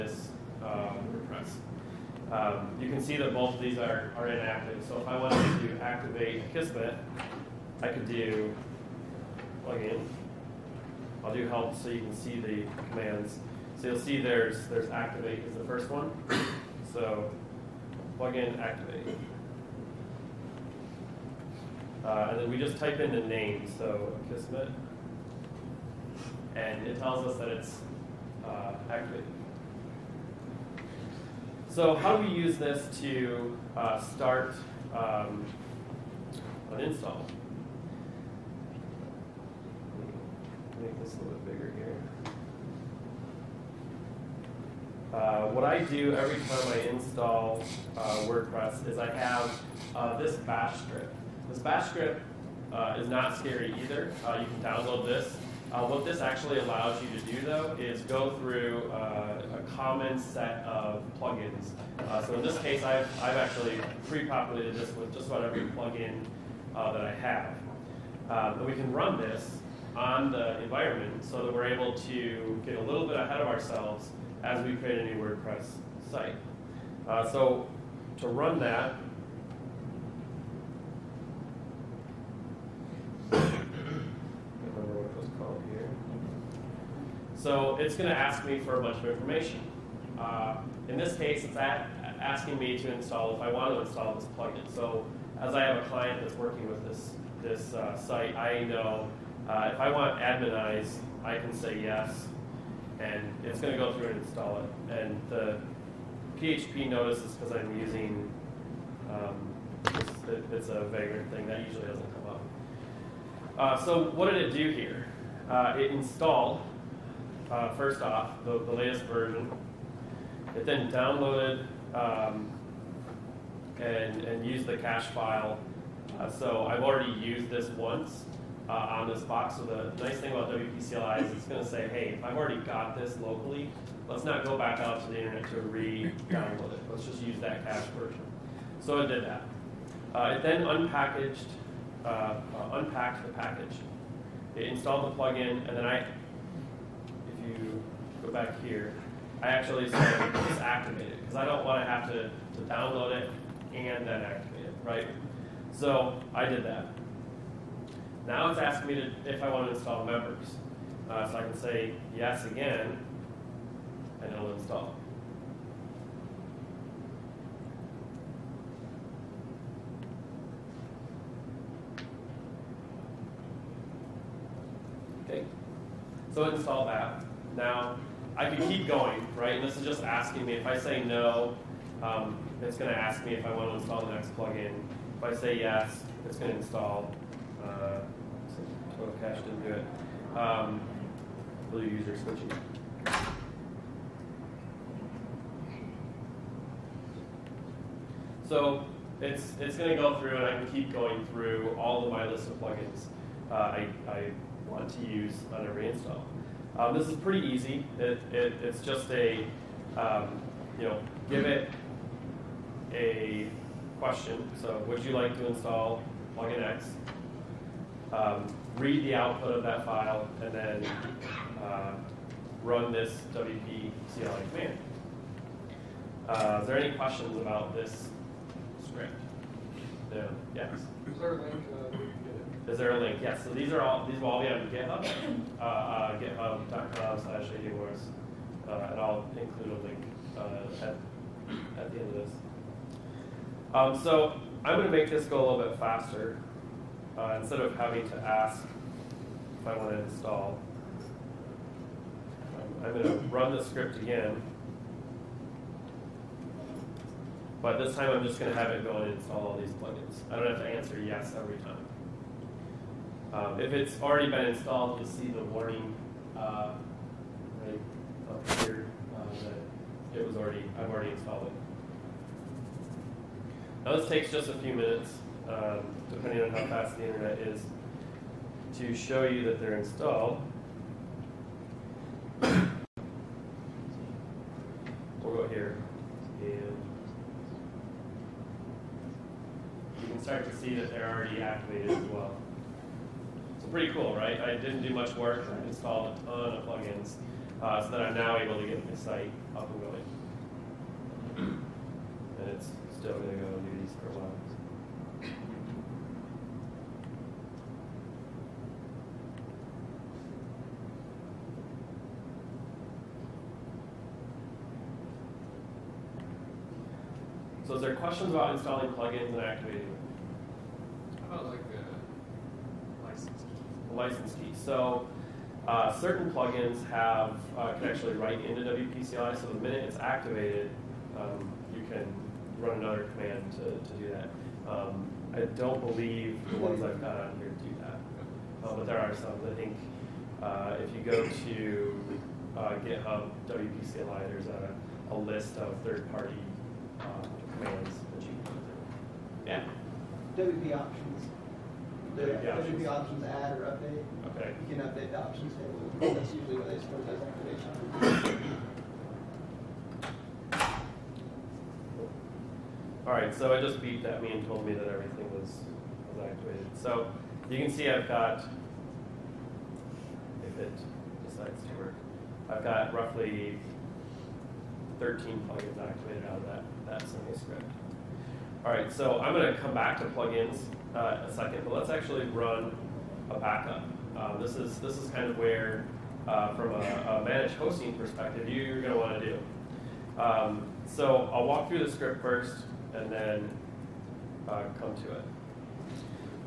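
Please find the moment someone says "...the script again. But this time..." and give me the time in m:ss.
4:13.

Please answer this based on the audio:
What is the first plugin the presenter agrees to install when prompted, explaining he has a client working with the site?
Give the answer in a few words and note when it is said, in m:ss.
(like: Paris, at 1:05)
Adminimize, at 1:40.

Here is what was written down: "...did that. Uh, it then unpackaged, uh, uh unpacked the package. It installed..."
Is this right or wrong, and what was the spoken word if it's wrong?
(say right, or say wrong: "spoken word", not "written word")
right.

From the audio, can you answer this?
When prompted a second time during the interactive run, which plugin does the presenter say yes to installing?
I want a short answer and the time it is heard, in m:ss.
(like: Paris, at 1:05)
Members, at 2:40.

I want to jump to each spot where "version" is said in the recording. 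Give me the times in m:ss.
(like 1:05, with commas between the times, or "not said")
1:59, 2:17.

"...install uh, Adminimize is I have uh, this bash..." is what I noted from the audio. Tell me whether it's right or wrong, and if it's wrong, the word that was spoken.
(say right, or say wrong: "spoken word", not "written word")
wrong: "WordPress", not "Adminimize".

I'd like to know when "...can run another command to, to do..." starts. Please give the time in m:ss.
5:31.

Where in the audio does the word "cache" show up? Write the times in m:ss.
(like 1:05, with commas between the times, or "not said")
2:04, 2:17, 3:09.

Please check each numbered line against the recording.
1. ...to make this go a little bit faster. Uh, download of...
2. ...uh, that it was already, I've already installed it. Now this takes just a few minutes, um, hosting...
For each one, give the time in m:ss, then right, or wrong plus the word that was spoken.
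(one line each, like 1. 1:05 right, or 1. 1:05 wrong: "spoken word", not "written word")
1. 4:04 wrong: "instead", not "download"
2. 4:29 wrong: "depending", not "hosting".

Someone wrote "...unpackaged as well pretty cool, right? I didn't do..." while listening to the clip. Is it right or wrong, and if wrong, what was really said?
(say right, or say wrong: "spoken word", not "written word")
wrong: "activated", not "unpackaged".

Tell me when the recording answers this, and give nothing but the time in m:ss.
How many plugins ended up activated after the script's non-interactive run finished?
6:15.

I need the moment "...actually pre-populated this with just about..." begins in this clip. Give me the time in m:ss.
1:03.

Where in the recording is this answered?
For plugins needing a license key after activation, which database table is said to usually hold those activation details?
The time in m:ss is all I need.
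5:55.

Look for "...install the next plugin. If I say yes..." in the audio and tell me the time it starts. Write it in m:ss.
3:03.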